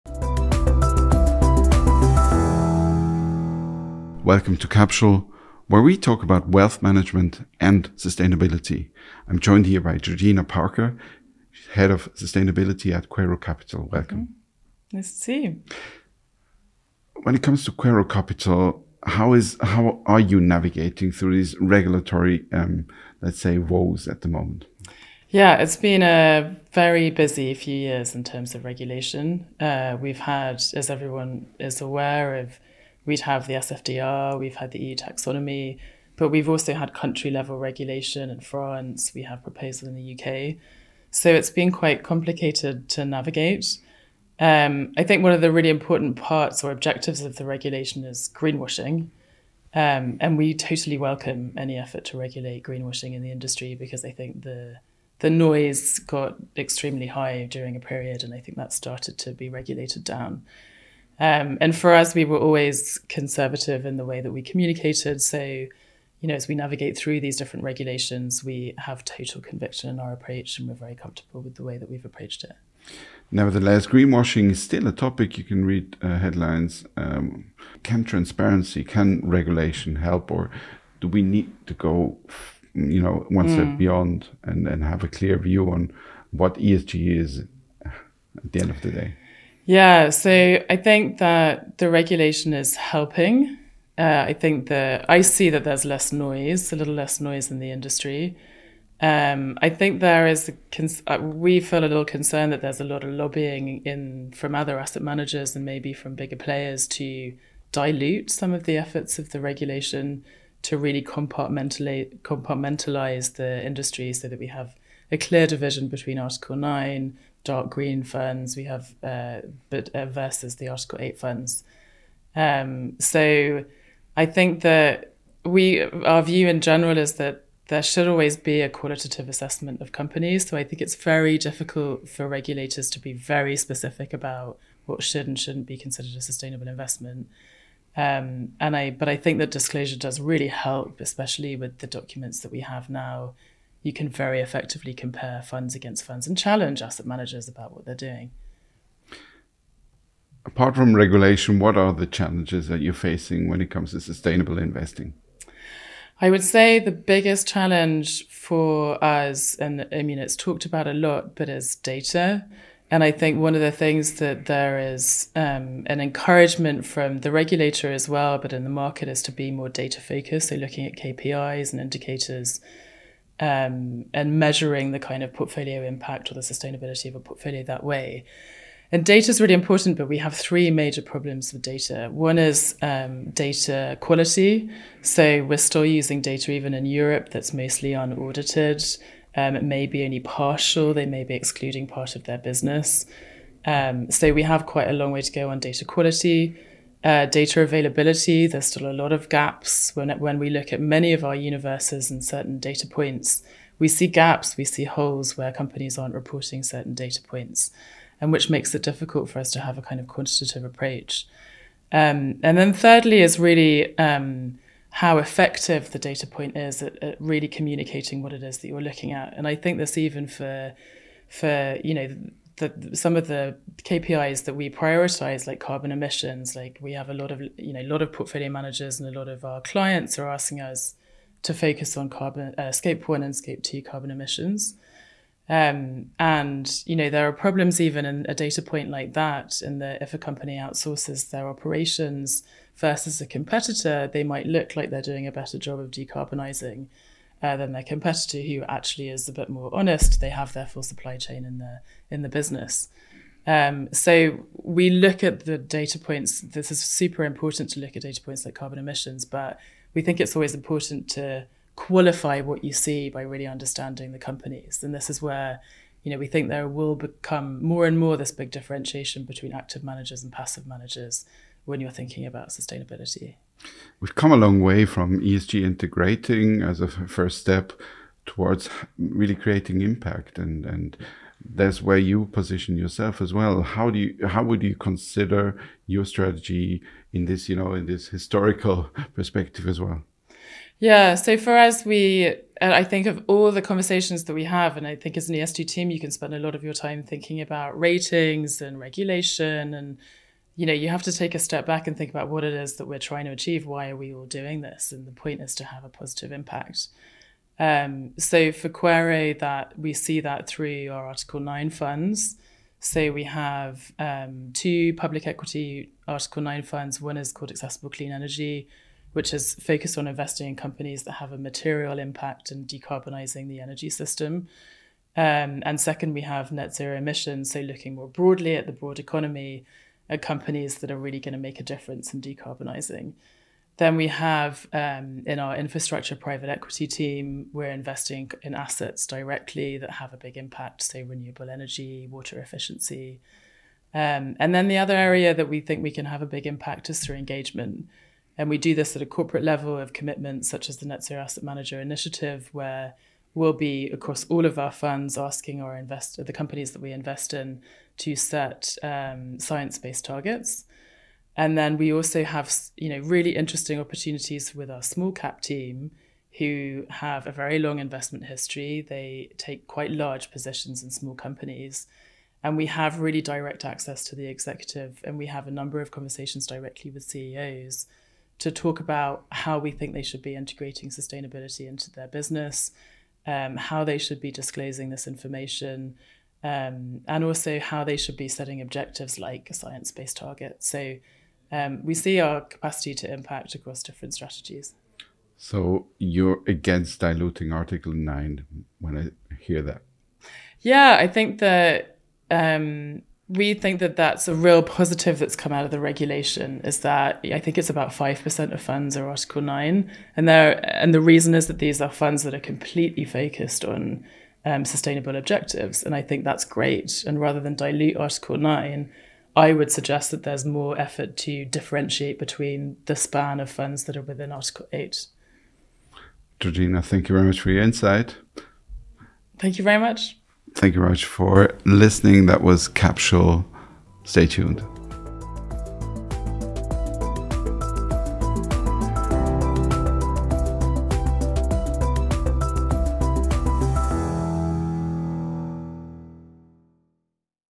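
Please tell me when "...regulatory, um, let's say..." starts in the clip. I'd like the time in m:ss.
0:21.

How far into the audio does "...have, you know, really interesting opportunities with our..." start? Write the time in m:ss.
6:02.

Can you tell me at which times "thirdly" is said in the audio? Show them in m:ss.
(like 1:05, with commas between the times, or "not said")
3:32.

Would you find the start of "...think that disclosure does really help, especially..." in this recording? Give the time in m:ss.
2:19.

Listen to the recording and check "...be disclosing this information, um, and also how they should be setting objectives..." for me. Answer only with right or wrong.
right.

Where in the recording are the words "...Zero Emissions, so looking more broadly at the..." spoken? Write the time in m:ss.
5:26.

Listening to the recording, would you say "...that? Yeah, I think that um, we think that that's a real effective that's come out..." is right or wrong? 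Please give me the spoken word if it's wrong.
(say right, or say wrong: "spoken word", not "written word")
wrong: "positive", not "effective".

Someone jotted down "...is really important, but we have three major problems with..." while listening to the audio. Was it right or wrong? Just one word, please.
right.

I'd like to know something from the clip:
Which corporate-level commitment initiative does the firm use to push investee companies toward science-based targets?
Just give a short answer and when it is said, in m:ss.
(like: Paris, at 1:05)
Net Zero Asset Manager Initiative, at 5:50.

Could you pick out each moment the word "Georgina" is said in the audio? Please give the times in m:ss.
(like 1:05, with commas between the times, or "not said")
0:09, 7:06.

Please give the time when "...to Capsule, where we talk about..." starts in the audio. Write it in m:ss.
0:04.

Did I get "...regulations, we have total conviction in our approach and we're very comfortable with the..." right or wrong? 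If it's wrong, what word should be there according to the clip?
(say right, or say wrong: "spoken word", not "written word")
right.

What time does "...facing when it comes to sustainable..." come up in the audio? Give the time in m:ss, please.
2:32.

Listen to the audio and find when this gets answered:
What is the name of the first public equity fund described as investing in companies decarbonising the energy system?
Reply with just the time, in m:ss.
5:17.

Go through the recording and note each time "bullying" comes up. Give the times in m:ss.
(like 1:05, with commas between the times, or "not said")
not said.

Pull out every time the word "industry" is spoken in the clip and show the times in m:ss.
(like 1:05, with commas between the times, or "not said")
0:53, 1:37, 1:53.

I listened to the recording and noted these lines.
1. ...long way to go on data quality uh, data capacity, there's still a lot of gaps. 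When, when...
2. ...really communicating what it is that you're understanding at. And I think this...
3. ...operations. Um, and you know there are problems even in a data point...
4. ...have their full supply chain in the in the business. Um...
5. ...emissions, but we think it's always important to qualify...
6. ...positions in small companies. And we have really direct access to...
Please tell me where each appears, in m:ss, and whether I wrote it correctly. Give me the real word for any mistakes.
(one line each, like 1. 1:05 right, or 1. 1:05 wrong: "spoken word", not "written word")
1. 3:14 wrong: "availability", not "capacity"
2. 3:37 wrong: "looking", not "understanding"
3. 3:54 wrong: "emissions", not "operations"
4. 4:10 right
5. 4:18 right
6. 6:10 right.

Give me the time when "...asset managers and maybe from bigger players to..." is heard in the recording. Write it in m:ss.
1:44.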